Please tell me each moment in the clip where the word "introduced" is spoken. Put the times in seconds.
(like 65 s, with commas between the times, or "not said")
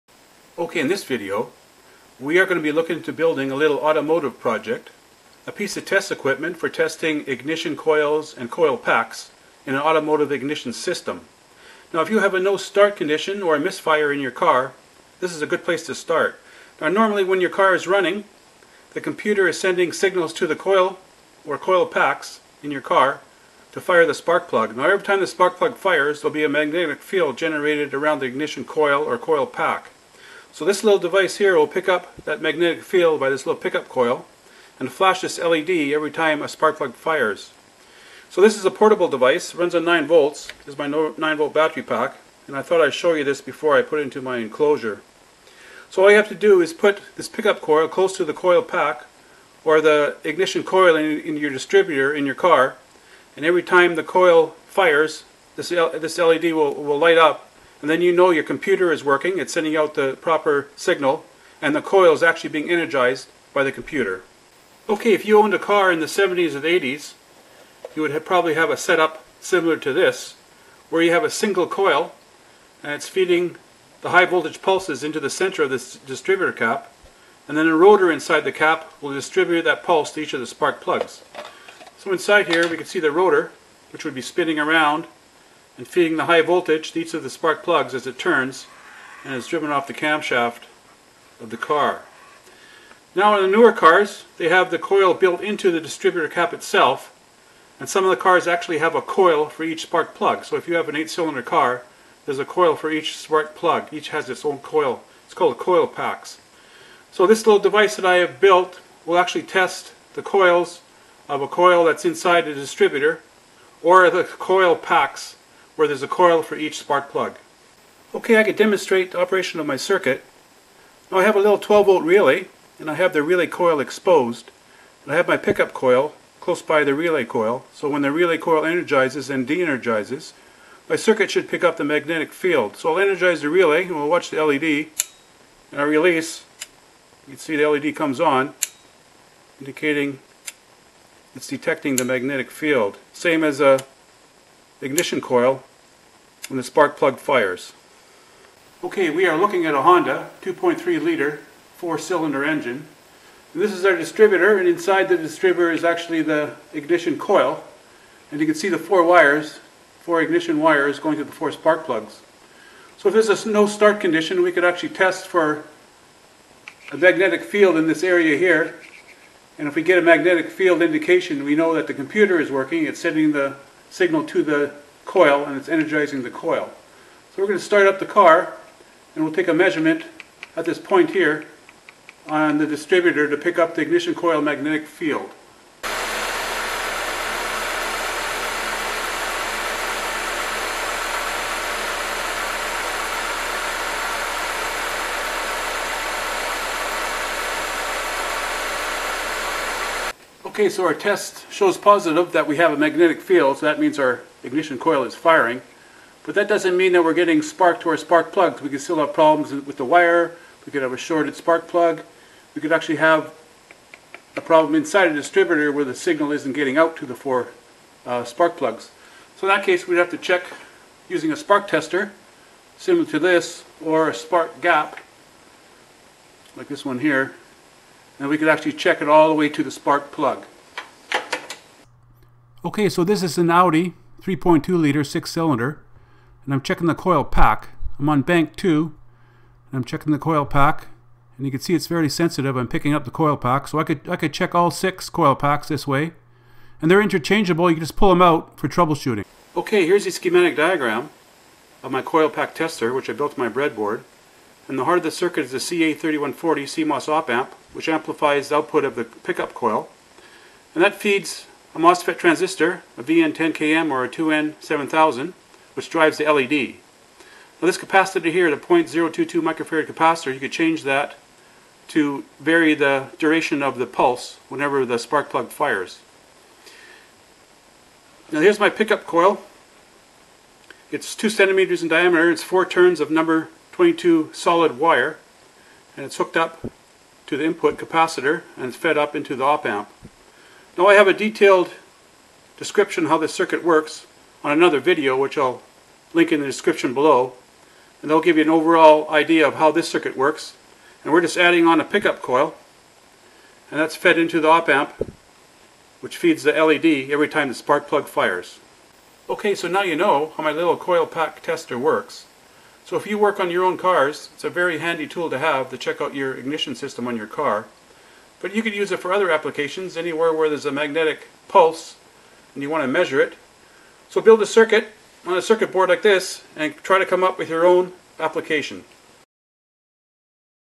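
not said.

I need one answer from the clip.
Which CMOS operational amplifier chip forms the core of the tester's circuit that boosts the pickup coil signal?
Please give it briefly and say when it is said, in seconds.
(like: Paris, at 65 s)
CA3140, at 255 s.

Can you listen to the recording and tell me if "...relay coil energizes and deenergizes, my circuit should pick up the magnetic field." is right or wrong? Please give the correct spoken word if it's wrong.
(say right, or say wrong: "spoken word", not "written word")
right.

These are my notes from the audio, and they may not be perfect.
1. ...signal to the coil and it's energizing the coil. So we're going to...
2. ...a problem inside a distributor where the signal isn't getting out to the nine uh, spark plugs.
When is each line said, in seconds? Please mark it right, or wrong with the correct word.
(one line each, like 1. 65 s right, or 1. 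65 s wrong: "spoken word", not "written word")
1. 173 s right
2. 214 s wrong: "four", not "nine".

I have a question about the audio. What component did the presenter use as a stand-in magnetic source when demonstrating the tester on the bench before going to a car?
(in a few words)
12 volt relay.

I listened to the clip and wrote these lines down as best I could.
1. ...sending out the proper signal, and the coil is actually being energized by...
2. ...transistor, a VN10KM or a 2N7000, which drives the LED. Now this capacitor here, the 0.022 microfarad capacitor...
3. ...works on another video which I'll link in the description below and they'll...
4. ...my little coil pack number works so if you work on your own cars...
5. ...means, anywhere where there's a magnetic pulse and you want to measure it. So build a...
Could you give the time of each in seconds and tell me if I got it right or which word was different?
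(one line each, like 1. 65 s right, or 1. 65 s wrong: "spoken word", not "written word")
1. 59 s right
2. 262 s right
3. 293 s right
4. 310 s wrong: "tester", not "number"
5. 319 s wrong: "applications", not "means".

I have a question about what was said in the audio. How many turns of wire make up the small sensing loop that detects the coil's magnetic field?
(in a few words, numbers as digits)
4.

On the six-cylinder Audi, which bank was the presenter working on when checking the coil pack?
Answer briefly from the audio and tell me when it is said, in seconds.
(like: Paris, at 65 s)
Bank 2, at 238 s.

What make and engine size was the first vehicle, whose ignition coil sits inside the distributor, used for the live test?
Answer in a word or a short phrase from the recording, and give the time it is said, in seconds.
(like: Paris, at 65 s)
Honda 2.3 liter, at 149 s.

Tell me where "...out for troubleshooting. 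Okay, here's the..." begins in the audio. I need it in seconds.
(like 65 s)
248 s.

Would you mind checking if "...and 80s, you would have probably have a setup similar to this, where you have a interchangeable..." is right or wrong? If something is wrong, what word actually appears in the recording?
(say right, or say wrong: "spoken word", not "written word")
wrong: "single", not "interchangeable".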